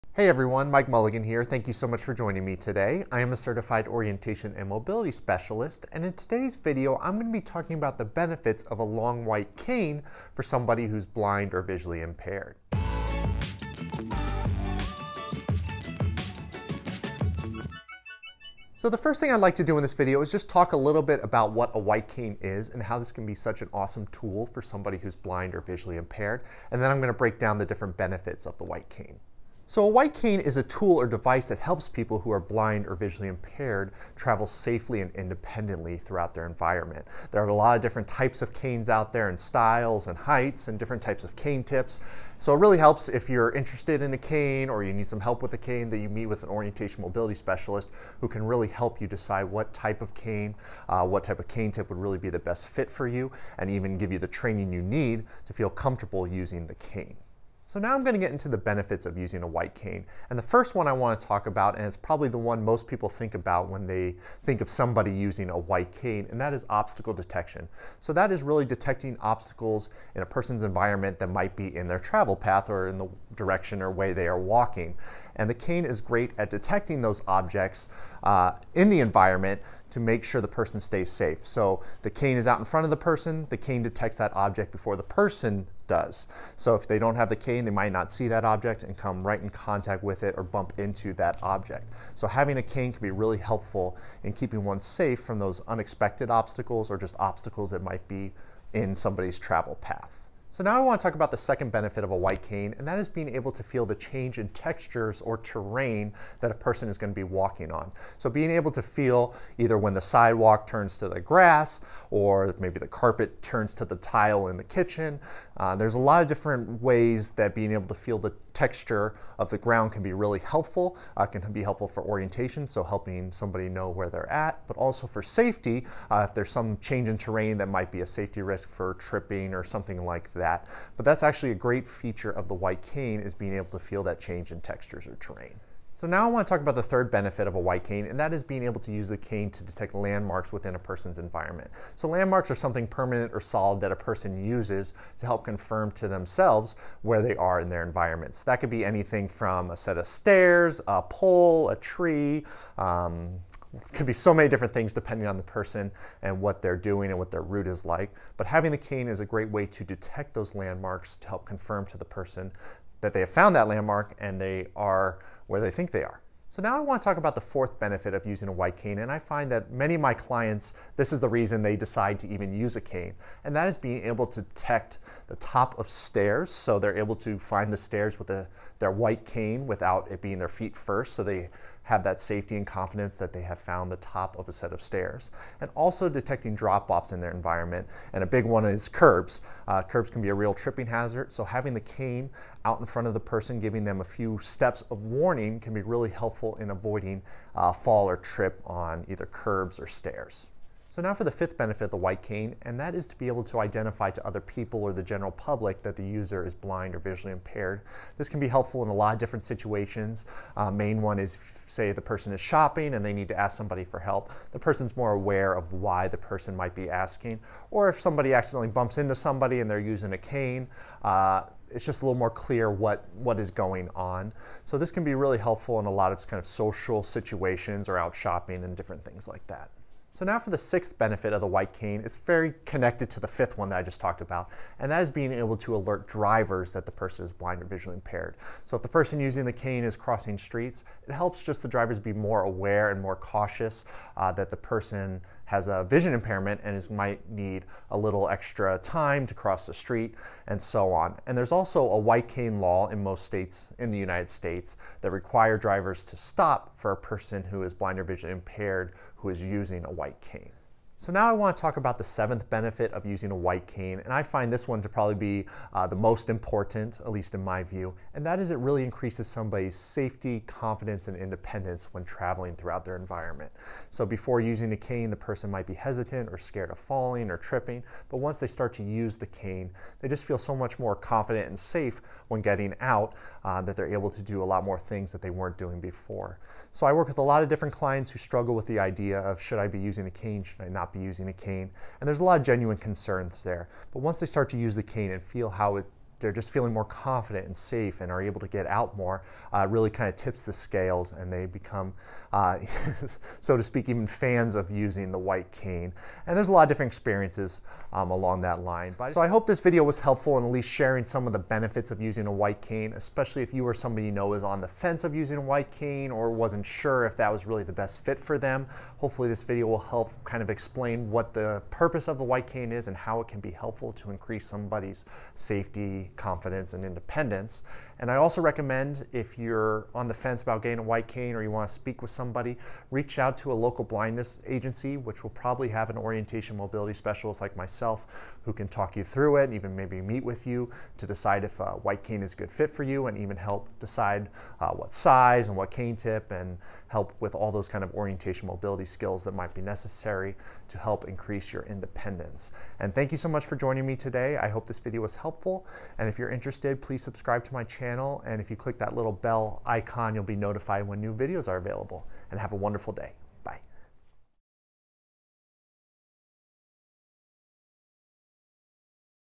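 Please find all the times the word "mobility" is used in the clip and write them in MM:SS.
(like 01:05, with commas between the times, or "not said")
00:04, 00:47, 05:36, 05:48.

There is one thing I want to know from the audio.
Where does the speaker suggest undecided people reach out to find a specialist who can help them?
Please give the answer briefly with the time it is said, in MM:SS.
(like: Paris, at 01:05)
A local blindness agency, at 05:33.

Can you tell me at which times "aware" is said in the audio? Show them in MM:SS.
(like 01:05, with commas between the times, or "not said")
03:35, 04:02.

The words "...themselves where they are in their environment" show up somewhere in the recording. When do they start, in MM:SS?
02:26.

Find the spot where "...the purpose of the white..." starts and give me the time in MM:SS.
05:21.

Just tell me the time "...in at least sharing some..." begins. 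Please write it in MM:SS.
05:10.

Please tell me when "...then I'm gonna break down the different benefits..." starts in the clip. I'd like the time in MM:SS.
00:26.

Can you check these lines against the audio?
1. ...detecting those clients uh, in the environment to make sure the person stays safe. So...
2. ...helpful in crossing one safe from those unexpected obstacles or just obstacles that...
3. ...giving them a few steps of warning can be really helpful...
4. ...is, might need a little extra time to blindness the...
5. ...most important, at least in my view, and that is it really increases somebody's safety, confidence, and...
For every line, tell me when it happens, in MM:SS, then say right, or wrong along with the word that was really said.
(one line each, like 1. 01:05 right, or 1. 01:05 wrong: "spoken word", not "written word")
1. 01:16 wrong: "objects", not "clients"
2. 01:33 wrong: "keeping", not "crossing"
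3. 03:13 right
4. 04:06 wrong: "cross", not "blindness"
5. 04:25 right.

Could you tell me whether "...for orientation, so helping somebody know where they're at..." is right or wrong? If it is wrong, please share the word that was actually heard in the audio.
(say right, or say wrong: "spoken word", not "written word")
right.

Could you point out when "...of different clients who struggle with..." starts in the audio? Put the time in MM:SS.
04:47.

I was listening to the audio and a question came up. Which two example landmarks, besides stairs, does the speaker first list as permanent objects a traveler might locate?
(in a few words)
A pole, a tree.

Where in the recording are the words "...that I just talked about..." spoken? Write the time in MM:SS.
03:53.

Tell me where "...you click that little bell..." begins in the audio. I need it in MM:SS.
05:58.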